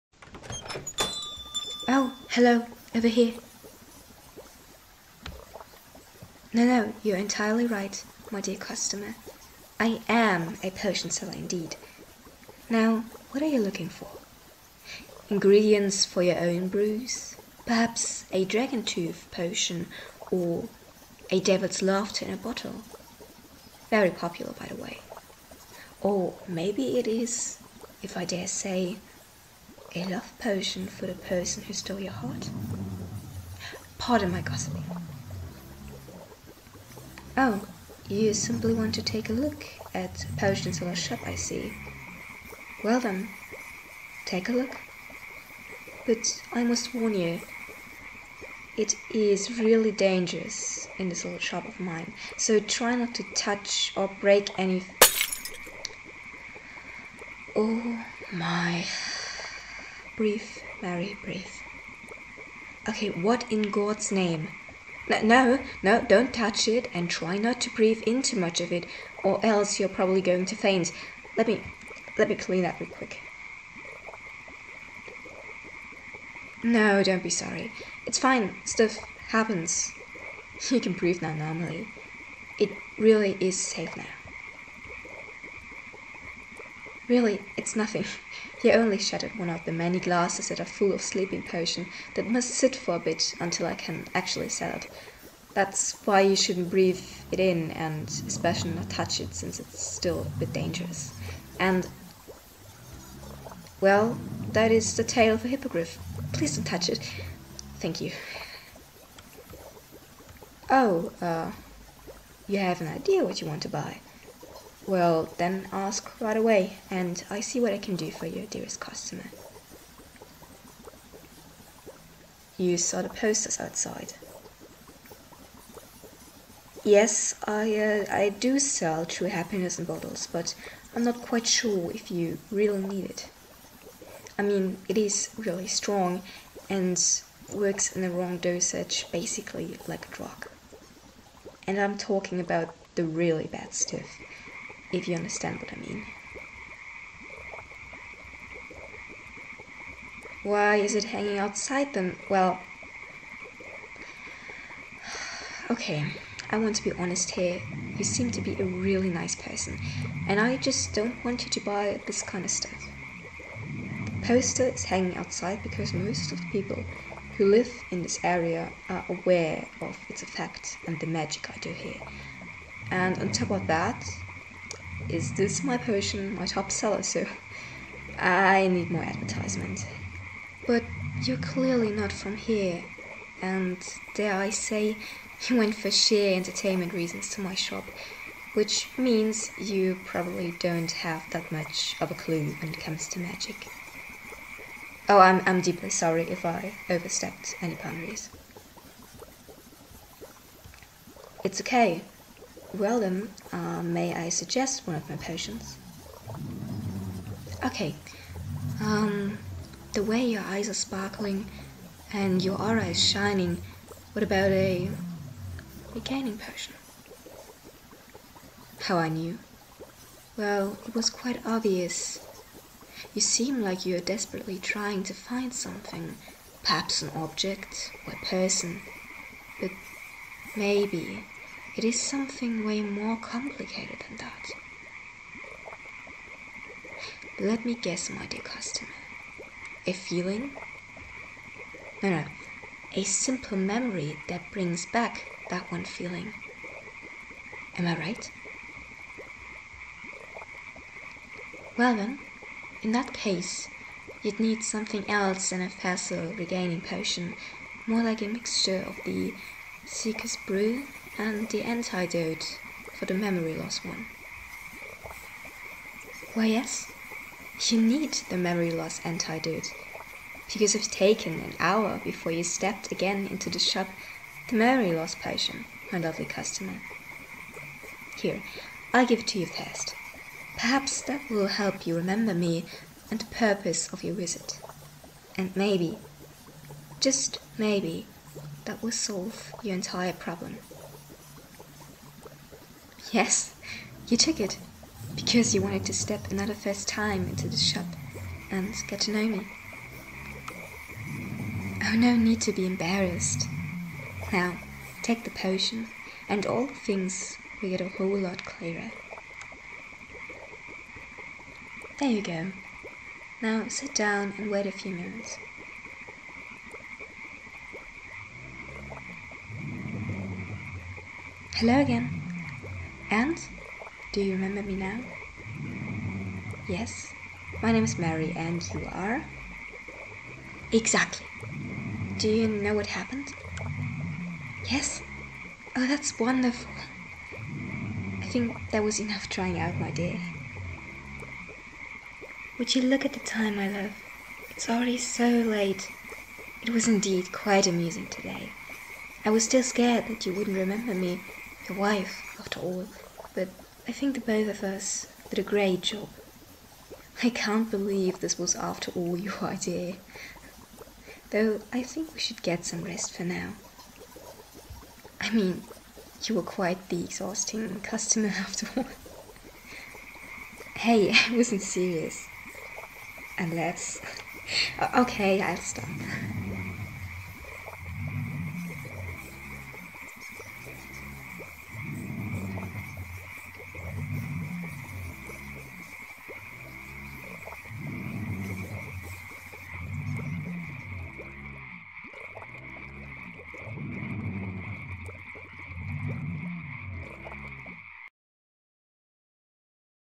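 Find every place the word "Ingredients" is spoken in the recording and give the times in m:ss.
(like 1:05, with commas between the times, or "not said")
0:15.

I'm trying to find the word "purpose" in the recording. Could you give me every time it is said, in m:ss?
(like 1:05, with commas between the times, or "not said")
4:43.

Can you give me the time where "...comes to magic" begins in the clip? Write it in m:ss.
3:12.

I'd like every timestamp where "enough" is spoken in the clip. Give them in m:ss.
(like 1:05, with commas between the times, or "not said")
5:39.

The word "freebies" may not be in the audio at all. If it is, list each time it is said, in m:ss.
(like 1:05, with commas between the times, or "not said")
not said.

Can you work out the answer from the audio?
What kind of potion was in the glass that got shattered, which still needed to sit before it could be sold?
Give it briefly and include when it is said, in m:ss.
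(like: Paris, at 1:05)
Sleeping potion, at 1:31.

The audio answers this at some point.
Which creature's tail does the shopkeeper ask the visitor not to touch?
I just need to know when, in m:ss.
1:45.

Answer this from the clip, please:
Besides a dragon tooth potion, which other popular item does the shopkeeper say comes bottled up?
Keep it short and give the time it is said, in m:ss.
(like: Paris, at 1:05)
Devil's laughter, at 0:21.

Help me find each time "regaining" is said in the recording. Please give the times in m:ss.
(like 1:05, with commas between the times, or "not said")
3:35, 4:16.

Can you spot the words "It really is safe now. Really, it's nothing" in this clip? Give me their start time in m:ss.
1:22.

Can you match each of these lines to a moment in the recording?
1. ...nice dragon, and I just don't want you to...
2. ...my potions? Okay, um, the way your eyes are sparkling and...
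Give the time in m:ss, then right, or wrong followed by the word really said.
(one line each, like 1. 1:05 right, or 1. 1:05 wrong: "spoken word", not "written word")
1. 2:39 wrong: "person", not "dragon"
2. 3:25 right.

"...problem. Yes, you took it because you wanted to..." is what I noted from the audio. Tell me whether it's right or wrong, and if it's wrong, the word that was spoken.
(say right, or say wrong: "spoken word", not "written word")
right.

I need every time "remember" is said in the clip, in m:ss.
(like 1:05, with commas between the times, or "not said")
4:41, 5:24, 5:50.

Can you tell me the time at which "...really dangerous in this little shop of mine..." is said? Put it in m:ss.
0:49.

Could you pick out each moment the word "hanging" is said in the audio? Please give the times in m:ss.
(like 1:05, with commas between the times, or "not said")
2:31, 2:44.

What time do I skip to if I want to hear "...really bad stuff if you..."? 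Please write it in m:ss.
2:23.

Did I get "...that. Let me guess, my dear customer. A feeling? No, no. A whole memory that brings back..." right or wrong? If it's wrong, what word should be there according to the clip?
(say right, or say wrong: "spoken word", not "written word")
wrong: "simple", not "whole".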